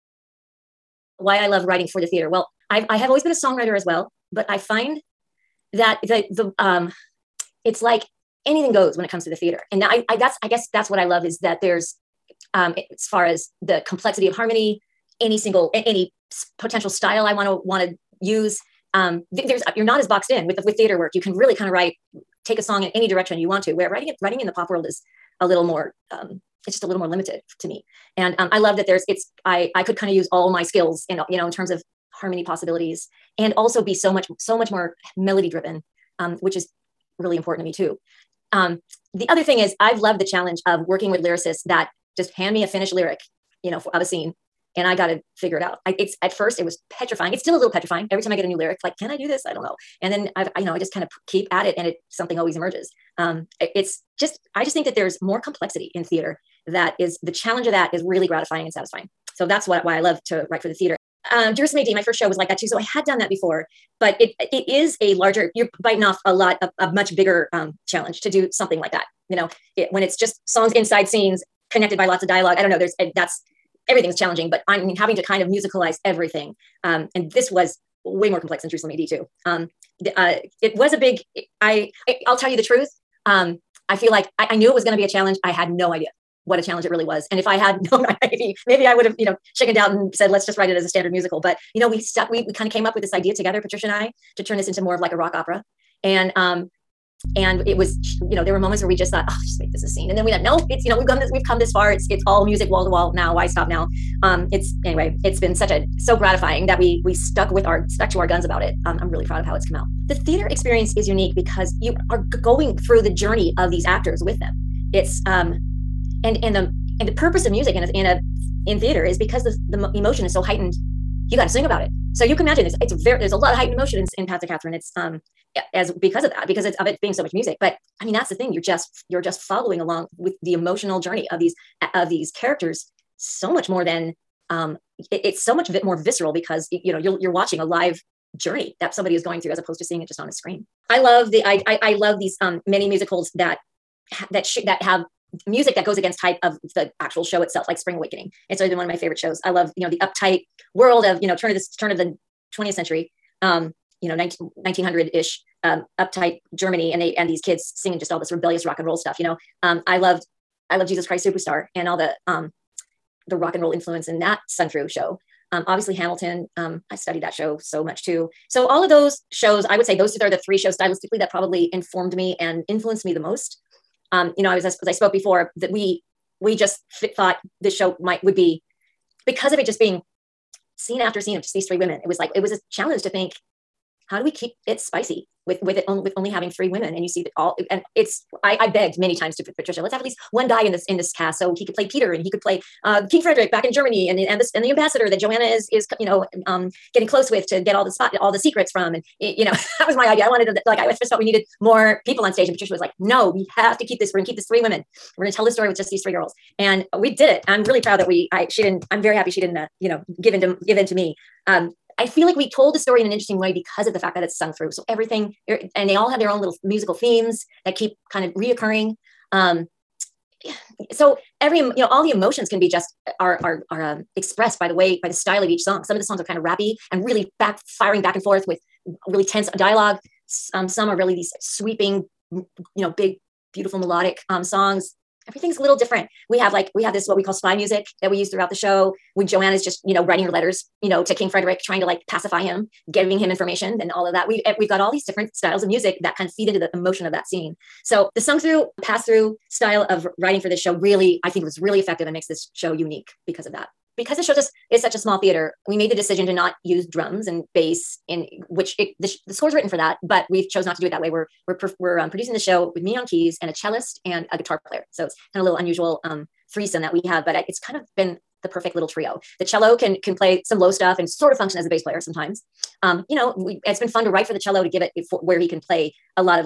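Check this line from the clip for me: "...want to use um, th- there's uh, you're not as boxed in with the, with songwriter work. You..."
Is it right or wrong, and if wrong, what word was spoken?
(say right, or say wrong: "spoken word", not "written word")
wrong: "theater", not "songwriter".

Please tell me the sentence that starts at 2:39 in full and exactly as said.
Um, I loved I love Jesus Christ Superstar and all the um, the rock and roll influence in that sung through show.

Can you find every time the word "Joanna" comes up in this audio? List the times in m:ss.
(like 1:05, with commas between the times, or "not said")
3:15, 3:59.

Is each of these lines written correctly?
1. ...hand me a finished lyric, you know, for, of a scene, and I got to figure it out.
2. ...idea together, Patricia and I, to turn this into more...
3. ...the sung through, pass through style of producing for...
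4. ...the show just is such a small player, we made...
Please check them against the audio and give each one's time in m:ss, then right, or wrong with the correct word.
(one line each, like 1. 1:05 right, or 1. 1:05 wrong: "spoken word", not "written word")
1. 0:42 right
2. 1:33 right
3. 4:08 wrong: "writing", not "producing"
4. 4:14 wrong: "theater", not "player".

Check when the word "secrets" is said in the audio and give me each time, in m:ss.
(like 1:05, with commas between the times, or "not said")
3:18.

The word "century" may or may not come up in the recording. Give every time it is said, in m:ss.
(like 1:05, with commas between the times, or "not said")
2:32.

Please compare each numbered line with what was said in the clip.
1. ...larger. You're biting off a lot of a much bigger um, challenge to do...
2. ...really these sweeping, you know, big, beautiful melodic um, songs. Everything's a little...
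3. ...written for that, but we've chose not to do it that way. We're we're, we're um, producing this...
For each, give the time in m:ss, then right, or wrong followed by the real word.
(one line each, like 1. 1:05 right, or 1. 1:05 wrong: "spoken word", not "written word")
1. 1:05 right
2. 3:50 right
3. 4:19 right.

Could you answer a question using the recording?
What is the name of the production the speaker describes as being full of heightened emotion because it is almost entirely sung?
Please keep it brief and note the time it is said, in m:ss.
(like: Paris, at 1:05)
Path to Catherine, at 2:04.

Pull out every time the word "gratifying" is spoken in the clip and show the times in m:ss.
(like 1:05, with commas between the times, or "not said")
0:58, 1:46.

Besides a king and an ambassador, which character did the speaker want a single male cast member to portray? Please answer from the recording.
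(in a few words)
Peter.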